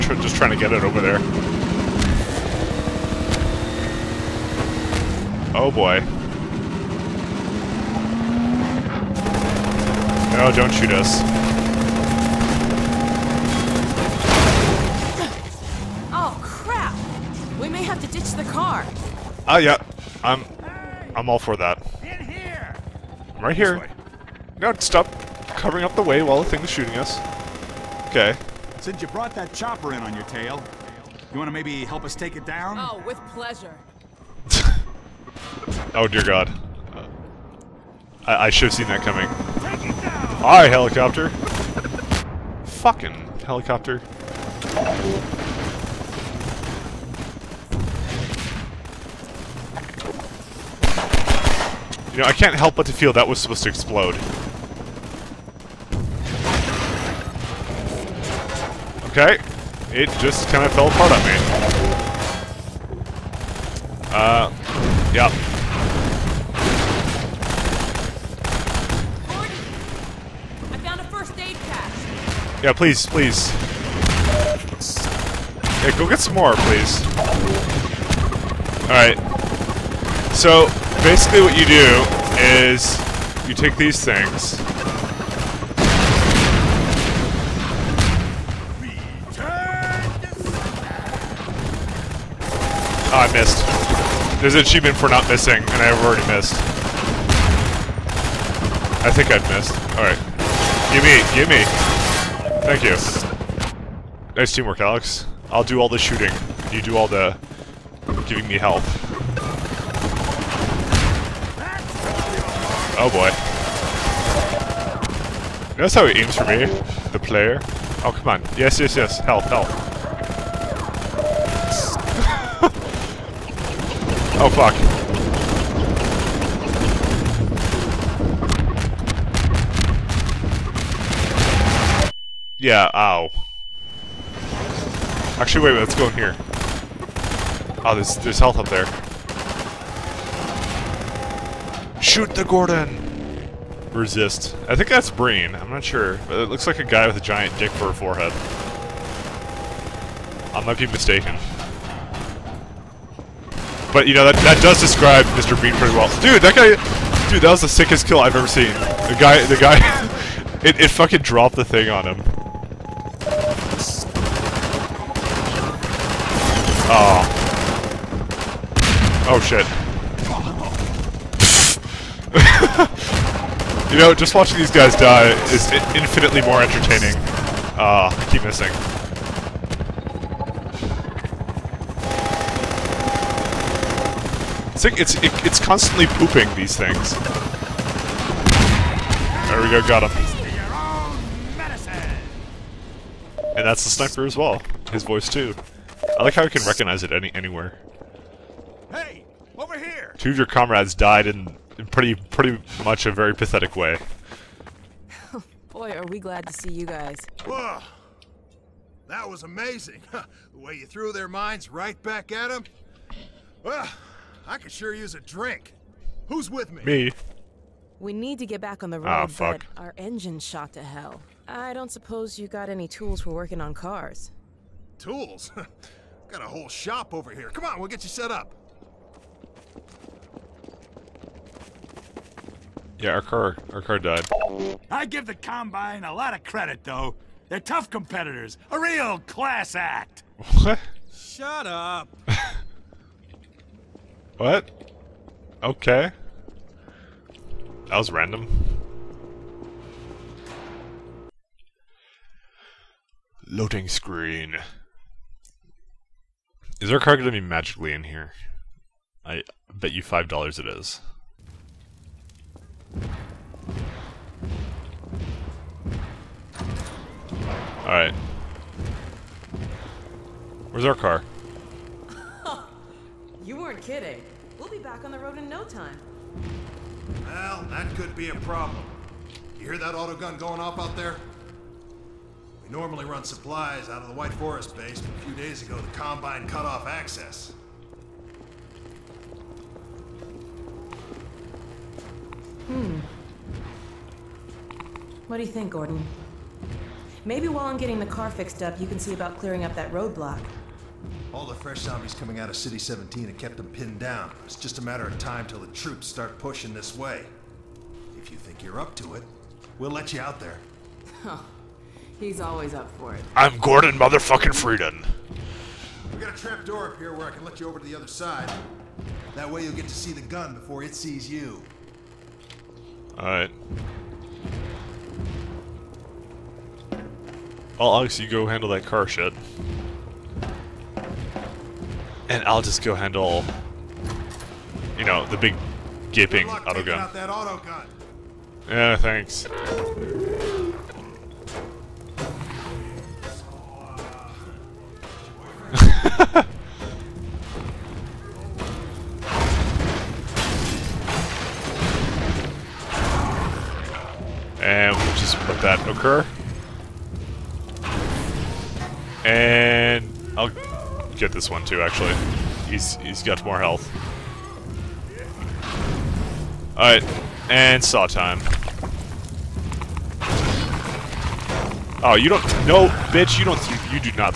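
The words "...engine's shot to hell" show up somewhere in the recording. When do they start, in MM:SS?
03:39.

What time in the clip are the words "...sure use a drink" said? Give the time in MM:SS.
03:34.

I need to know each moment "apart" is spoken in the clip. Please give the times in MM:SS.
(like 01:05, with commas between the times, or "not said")
01:00.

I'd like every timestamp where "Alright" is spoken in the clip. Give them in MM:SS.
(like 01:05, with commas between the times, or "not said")
00:40, 01:18, 01:39, 04:27, 05:23, 06:06.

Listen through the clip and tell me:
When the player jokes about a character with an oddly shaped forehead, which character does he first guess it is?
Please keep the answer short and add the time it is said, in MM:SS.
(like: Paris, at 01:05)
Breen, at 02:25.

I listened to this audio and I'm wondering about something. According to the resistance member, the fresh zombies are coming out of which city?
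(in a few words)
City 17.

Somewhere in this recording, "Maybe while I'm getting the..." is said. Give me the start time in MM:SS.
04:57.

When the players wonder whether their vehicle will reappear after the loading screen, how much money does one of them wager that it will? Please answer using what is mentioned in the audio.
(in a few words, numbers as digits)
$5.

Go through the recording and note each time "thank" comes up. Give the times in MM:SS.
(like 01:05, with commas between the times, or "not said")
01:42, 05:38.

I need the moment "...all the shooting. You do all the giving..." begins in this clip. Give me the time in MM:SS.
01:45.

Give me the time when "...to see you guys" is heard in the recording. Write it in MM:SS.
03:26.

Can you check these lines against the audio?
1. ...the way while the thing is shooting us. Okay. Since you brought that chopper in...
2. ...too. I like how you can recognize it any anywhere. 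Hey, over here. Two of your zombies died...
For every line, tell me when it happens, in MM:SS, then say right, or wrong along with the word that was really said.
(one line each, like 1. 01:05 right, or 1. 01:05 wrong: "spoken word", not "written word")
1. 00:25 right
2. 03:15 wrong: "comrades", not "zombies".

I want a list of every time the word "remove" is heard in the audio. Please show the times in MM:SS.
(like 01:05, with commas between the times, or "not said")
not said.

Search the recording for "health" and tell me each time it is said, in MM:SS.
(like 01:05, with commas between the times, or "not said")
02:18, 06:03.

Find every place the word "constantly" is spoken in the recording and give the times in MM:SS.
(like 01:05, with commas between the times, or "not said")
03:05.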